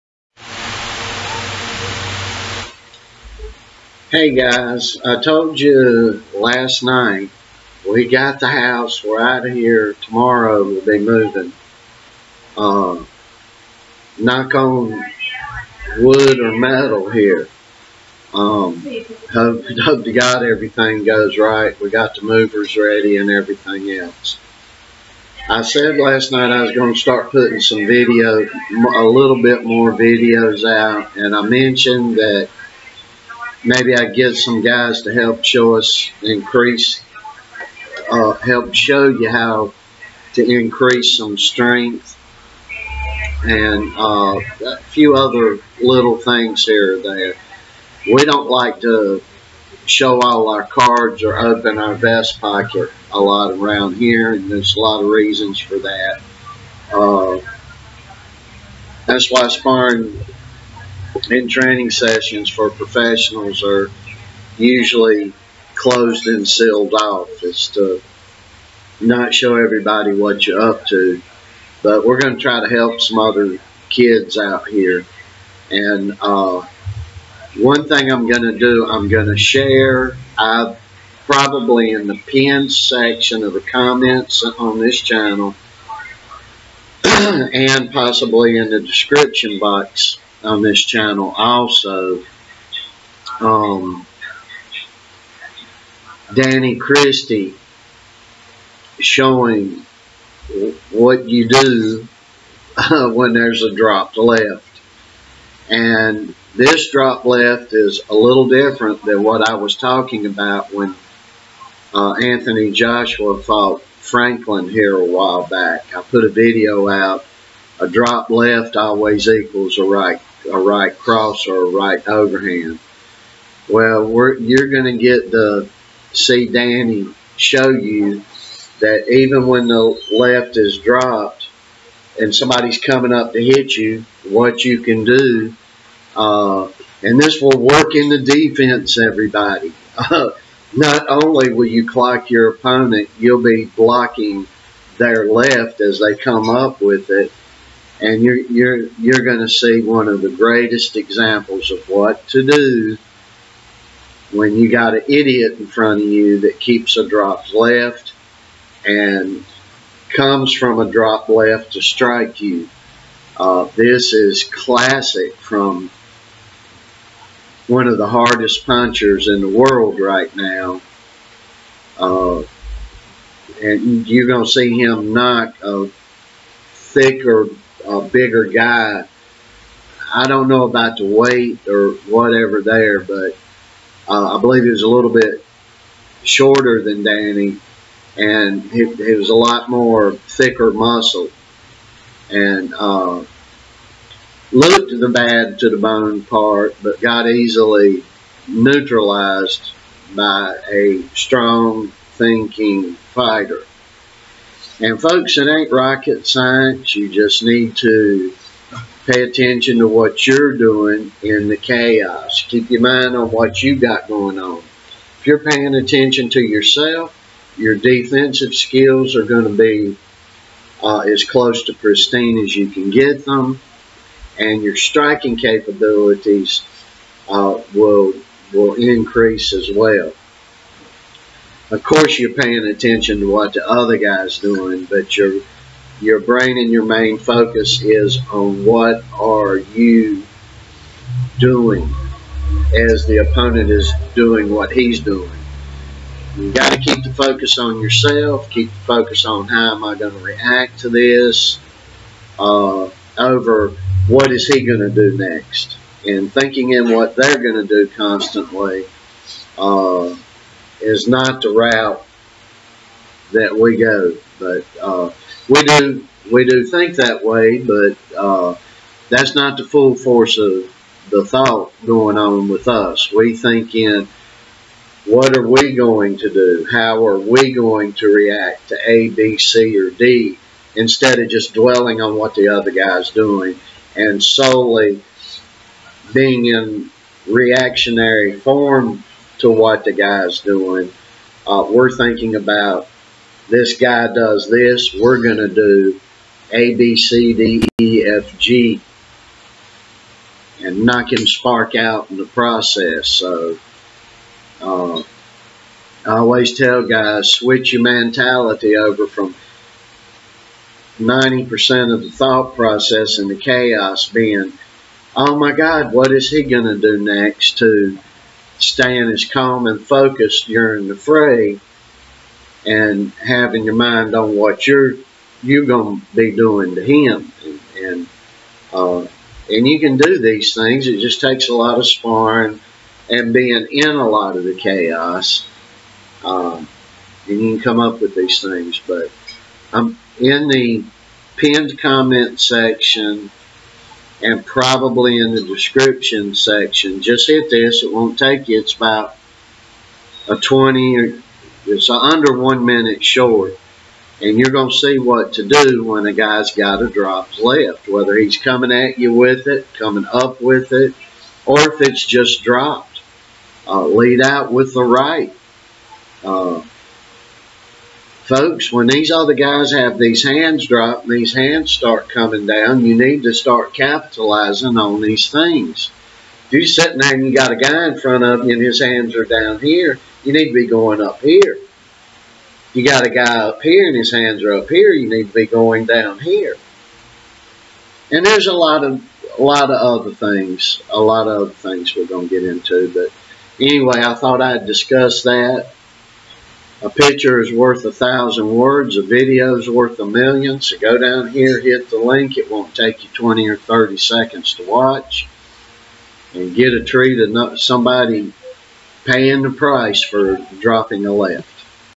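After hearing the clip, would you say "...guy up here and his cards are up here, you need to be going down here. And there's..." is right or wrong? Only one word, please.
wrong.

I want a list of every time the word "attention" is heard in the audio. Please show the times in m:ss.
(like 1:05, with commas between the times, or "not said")
3:29, 3:35, 3:52.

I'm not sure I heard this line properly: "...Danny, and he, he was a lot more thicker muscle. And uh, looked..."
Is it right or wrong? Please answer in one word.
right.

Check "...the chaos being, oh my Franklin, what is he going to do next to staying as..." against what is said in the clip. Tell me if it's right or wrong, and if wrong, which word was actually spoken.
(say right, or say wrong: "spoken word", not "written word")
wrong: "God", not "Franklin".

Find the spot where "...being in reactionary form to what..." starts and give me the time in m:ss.
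4:46.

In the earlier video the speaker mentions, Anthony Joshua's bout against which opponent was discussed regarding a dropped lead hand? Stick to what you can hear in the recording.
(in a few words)
Franklin.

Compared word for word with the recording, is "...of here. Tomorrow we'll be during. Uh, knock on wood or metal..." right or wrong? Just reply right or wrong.
wrong.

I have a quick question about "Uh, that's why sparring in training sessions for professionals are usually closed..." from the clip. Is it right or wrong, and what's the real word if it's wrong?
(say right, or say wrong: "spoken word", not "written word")
right.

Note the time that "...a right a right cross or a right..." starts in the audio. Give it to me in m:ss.
1:59.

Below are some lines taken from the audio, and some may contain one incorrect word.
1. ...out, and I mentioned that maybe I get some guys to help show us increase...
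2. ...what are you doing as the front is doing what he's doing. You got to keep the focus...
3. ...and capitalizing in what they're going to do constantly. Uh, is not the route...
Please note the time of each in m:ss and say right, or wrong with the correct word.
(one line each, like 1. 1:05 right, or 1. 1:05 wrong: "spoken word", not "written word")
1. 0:30 right
2. 3:58 wrong: "opponent", not "front"
3. 4:16 wrong: "thinking", not "capitalizing".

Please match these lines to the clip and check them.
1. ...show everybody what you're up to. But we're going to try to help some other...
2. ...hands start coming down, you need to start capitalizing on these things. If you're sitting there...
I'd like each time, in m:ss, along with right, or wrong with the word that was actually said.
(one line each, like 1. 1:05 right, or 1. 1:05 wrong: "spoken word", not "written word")
1. 1:09 right
2. 6:11 right.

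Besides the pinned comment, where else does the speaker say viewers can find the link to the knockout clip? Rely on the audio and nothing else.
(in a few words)
description box.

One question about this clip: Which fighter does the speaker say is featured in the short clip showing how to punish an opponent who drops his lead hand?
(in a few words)
Danny Christie.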